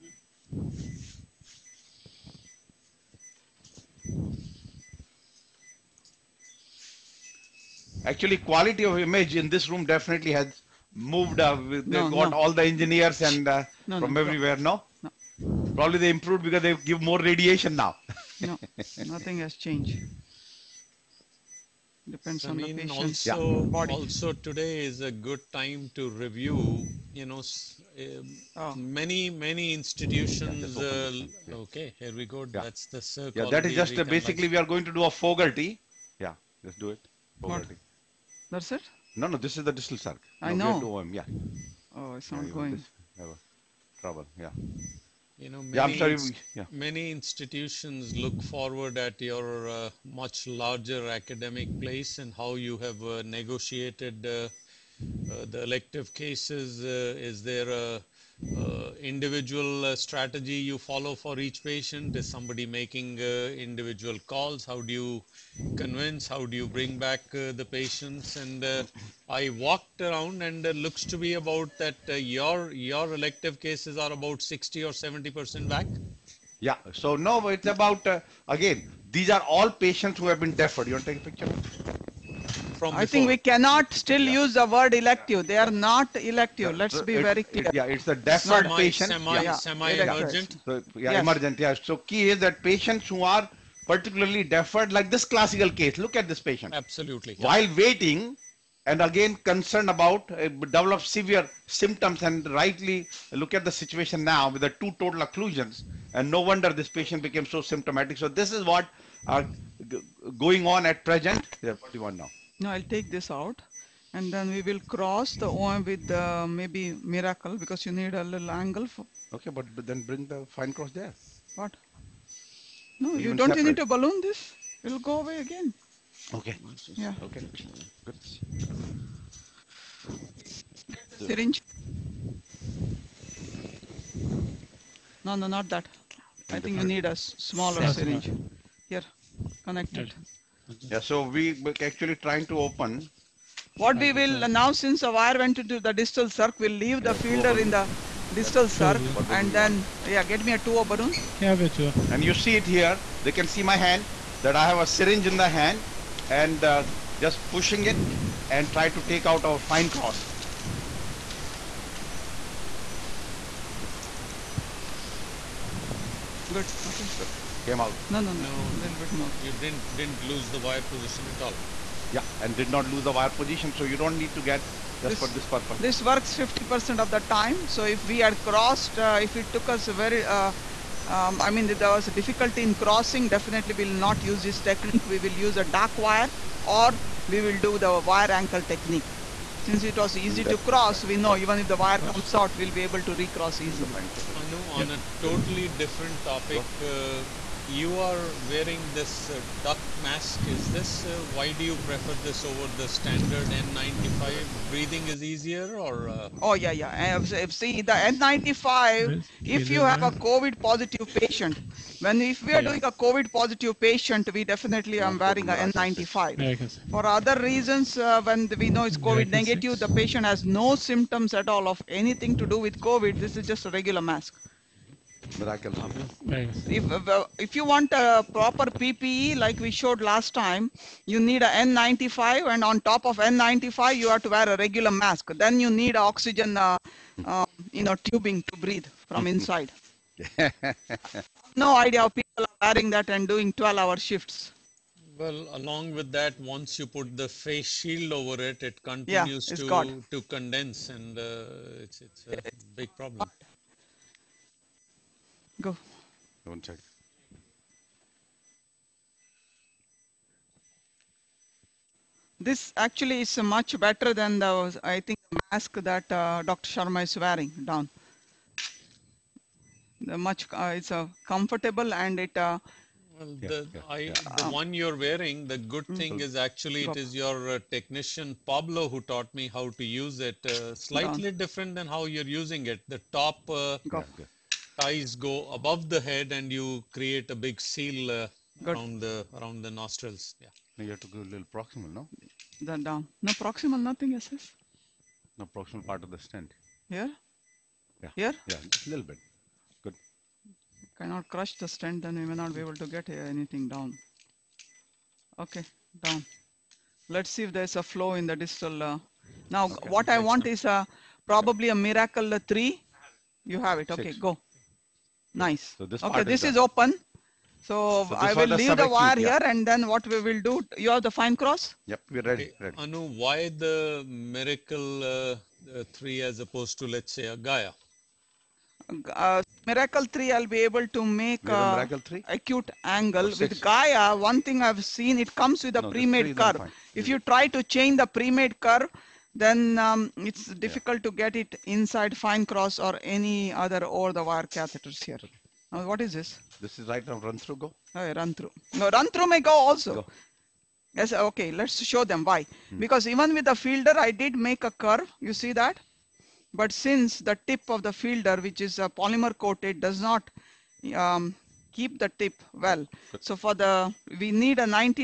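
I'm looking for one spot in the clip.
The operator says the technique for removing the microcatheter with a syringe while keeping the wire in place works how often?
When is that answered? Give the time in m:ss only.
2:56.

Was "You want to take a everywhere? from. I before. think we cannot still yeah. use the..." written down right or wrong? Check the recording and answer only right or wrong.
wrong.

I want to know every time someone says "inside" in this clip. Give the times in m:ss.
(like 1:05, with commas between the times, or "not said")
3:59, 5:41.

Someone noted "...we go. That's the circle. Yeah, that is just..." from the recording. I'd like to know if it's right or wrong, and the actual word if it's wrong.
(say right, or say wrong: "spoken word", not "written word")
right.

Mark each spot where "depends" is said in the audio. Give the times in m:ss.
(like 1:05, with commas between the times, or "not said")
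0:22.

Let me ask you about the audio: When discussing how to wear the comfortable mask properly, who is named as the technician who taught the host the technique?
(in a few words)
Pablo.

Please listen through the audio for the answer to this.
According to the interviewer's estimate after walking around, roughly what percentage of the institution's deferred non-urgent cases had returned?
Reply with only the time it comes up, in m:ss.
1:14.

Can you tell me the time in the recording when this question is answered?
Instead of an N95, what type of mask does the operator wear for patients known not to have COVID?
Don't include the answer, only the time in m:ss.
3:19.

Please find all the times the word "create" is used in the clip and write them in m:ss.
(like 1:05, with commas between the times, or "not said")
4:46.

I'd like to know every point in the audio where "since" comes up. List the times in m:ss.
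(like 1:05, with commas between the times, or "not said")
2:24, 3:09, 5:56.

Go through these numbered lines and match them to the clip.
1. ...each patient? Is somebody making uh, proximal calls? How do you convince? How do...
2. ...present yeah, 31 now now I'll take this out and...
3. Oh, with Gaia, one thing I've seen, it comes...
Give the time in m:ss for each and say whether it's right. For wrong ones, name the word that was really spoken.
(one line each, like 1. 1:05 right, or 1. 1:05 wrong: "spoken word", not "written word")
1. 1:01 wrong: "individual", not "proximal"
2. 1:51 wrong: "41", not "31"
3. 5:33 right.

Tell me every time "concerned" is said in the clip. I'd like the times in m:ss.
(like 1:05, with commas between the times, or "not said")
1:39.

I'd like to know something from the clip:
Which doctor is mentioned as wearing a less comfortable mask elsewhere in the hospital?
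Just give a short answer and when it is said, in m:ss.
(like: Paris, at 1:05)
Dr. Sharma, at 4:26.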